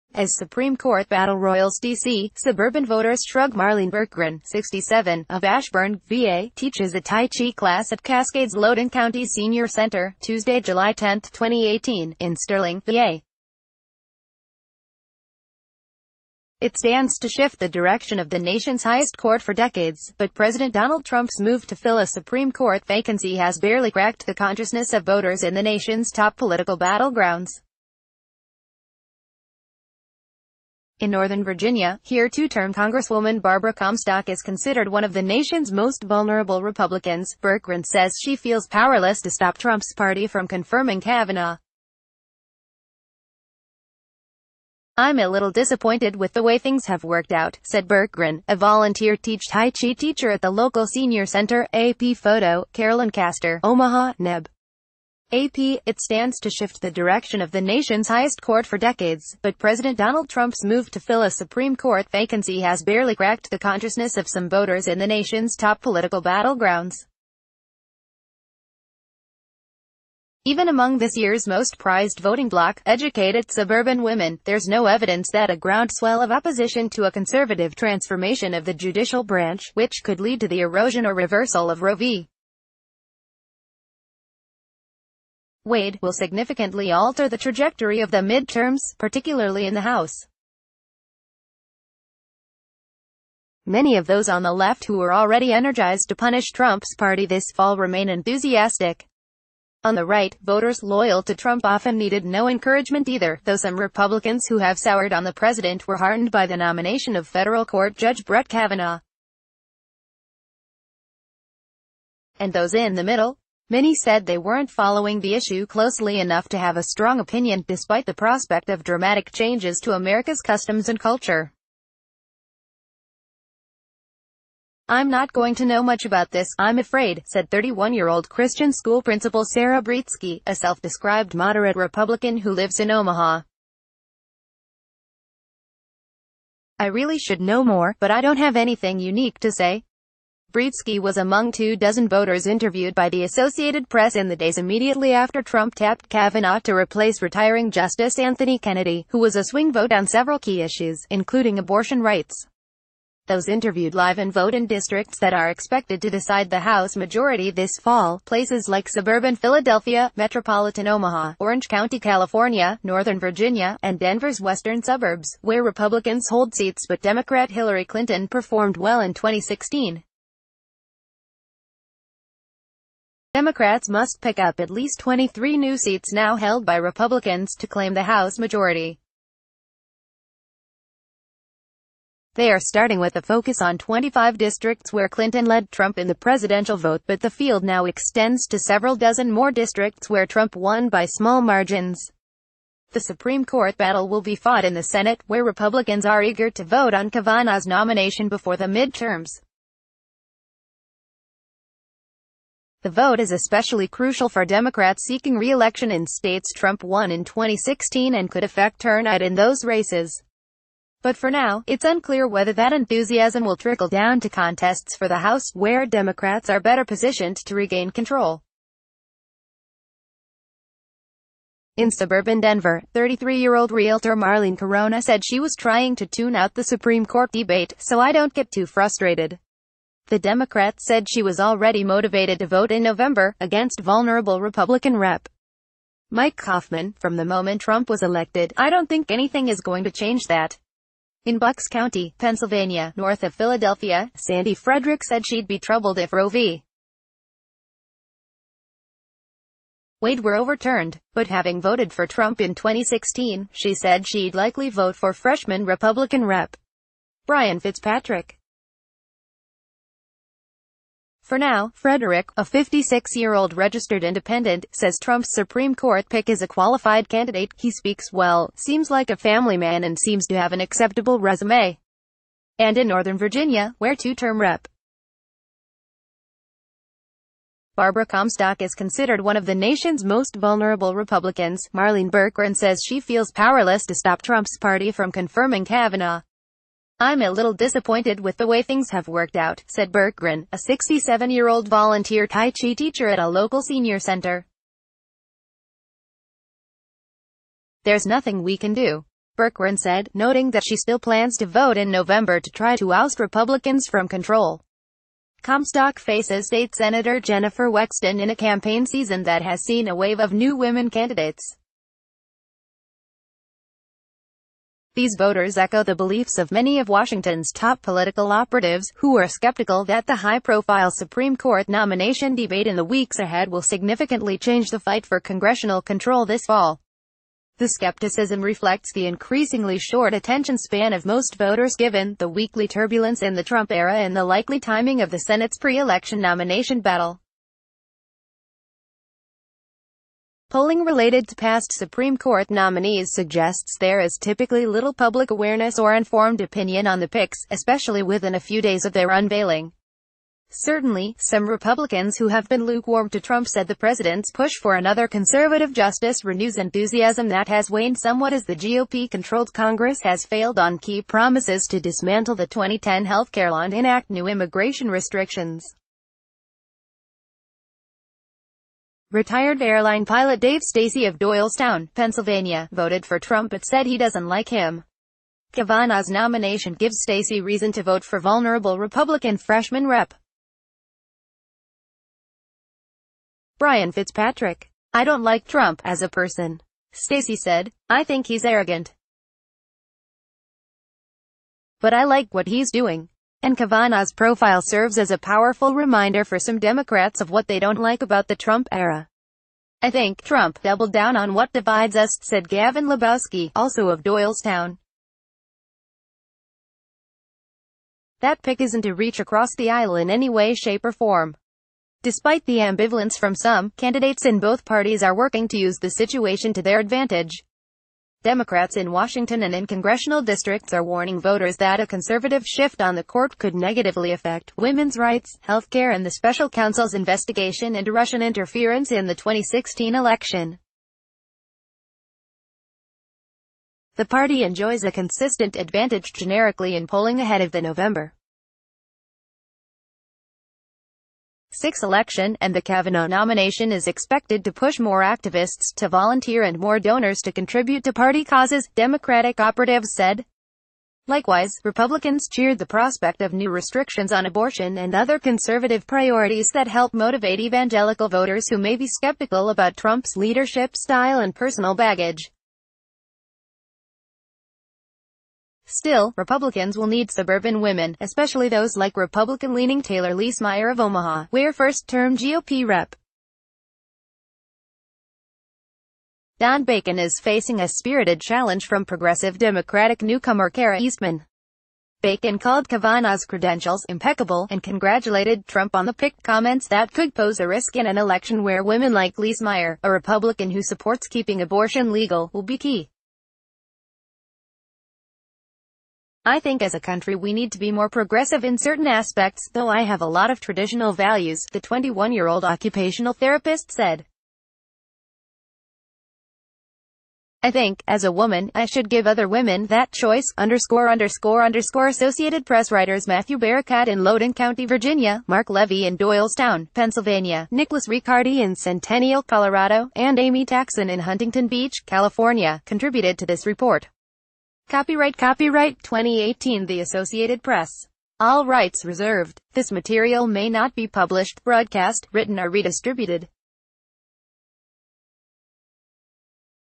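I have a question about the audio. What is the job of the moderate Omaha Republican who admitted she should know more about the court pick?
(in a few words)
Christian school principal.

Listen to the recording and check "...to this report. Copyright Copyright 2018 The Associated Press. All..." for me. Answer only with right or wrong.
right.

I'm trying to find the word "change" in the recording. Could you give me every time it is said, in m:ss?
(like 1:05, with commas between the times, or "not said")
1:59, 3:59, 5:24.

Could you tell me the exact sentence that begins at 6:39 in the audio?
I think Trump doubled down on what divides us, said Gavin Lebowski, also of Doylestown.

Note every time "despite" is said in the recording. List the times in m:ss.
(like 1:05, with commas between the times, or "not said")
1:57, 6:52.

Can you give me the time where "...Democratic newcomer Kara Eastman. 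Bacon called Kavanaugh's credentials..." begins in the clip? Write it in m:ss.
7:59.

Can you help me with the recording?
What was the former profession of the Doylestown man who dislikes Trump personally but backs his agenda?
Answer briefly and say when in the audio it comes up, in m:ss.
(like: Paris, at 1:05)
Airline pilot, at 6:09.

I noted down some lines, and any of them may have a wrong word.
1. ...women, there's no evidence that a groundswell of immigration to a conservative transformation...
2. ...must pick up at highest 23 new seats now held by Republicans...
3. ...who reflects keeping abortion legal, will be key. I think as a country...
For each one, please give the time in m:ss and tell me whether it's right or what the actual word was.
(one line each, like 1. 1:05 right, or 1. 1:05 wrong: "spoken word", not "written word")
1. 1:14 wrong: "opposition", not "immigration"
2. 2:53 wrong: "least", not "highest"
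3. 8:10 wrong: "supports", not "reflects".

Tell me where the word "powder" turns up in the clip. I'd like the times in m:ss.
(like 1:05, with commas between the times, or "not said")
not said.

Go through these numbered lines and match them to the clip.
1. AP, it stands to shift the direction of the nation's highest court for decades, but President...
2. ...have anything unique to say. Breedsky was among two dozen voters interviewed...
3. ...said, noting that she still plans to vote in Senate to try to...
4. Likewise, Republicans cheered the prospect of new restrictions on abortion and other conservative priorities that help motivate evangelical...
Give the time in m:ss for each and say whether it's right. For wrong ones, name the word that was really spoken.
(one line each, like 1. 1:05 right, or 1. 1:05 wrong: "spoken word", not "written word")
1. 0:55 right
2. 2:18 right
3. 4:59 wrong: "November", not "Senate"
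4. 7:31 right.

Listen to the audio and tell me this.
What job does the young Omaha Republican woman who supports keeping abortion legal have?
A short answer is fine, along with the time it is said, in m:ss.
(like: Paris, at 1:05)
Occupational therapist, at 8:22.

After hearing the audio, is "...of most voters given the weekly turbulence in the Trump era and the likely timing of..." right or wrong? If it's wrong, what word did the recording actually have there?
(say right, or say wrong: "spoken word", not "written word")
right.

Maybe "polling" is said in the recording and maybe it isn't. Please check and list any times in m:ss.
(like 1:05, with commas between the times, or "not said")
5:40, 7:16.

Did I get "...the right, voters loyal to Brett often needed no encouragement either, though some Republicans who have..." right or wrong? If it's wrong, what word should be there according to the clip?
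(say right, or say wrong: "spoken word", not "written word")
wrong: "Trump", not "Brett".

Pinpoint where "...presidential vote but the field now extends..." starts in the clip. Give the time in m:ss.
3:06.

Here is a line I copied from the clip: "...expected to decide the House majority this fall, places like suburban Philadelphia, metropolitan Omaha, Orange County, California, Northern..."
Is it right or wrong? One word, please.
right.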